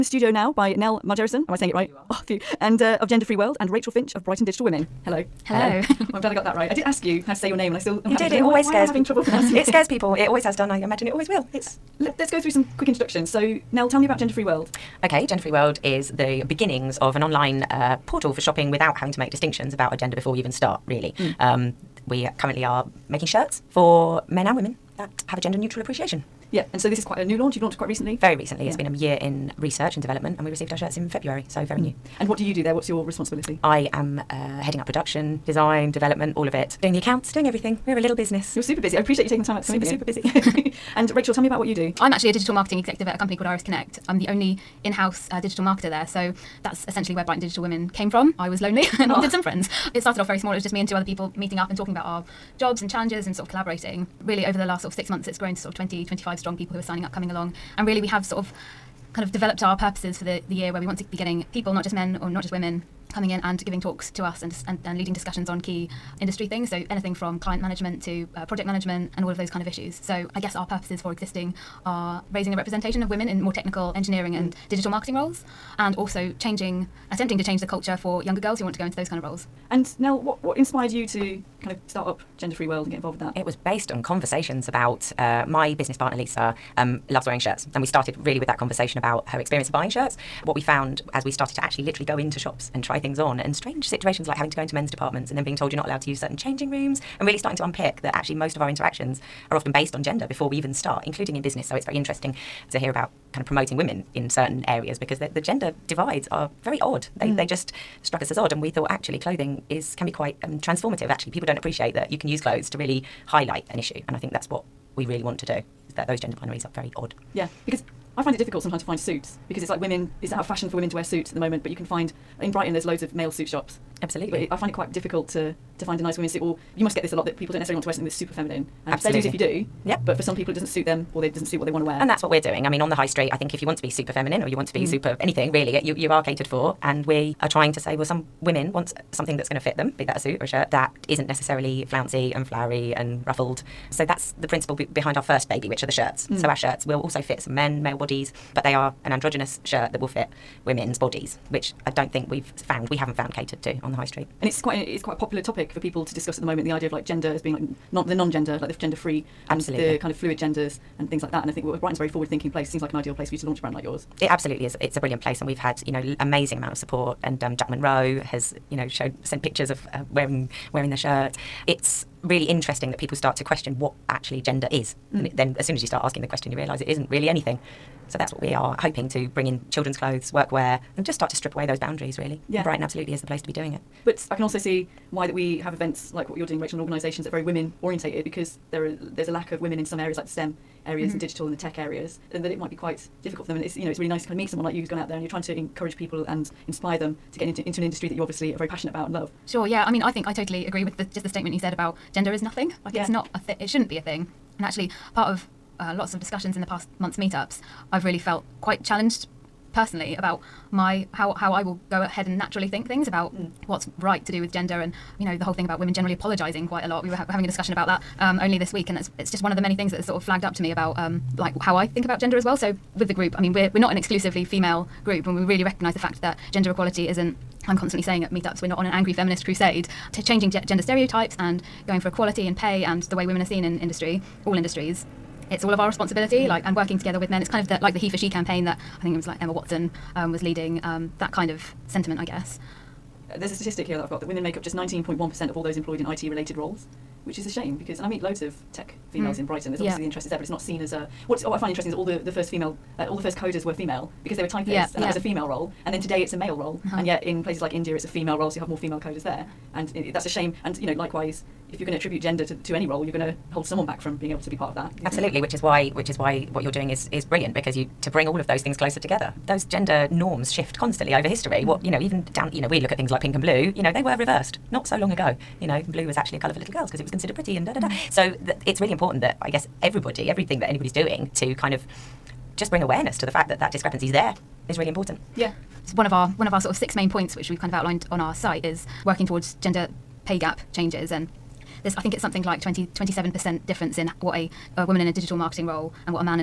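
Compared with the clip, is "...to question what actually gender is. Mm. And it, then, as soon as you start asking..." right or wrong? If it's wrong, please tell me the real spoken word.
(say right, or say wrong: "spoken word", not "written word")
right.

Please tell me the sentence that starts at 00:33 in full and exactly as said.
I am uh, heading up production, design, development, all of it.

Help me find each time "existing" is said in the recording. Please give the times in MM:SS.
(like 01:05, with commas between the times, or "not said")
01:11.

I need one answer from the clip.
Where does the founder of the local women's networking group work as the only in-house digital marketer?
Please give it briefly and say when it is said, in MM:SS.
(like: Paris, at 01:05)
Iris Connect, at 00:43.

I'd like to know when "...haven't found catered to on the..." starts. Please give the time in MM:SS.
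02:32.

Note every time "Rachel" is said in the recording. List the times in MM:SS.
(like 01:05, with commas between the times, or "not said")
00:03, 00:41, 03:06.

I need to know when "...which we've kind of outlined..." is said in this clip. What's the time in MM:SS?
04:47.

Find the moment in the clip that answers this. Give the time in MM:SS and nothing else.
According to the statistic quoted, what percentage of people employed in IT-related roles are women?
04:04.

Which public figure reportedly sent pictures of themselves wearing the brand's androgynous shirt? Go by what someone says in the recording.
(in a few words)
Jack Monroe.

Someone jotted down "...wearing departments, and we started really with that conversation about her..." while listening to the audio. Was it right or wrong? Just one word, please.
wrong.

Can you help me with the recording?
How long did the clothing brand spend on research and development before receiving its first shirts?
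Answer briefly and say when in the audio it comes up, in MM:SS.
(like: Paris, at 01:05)
A year, at 00:28.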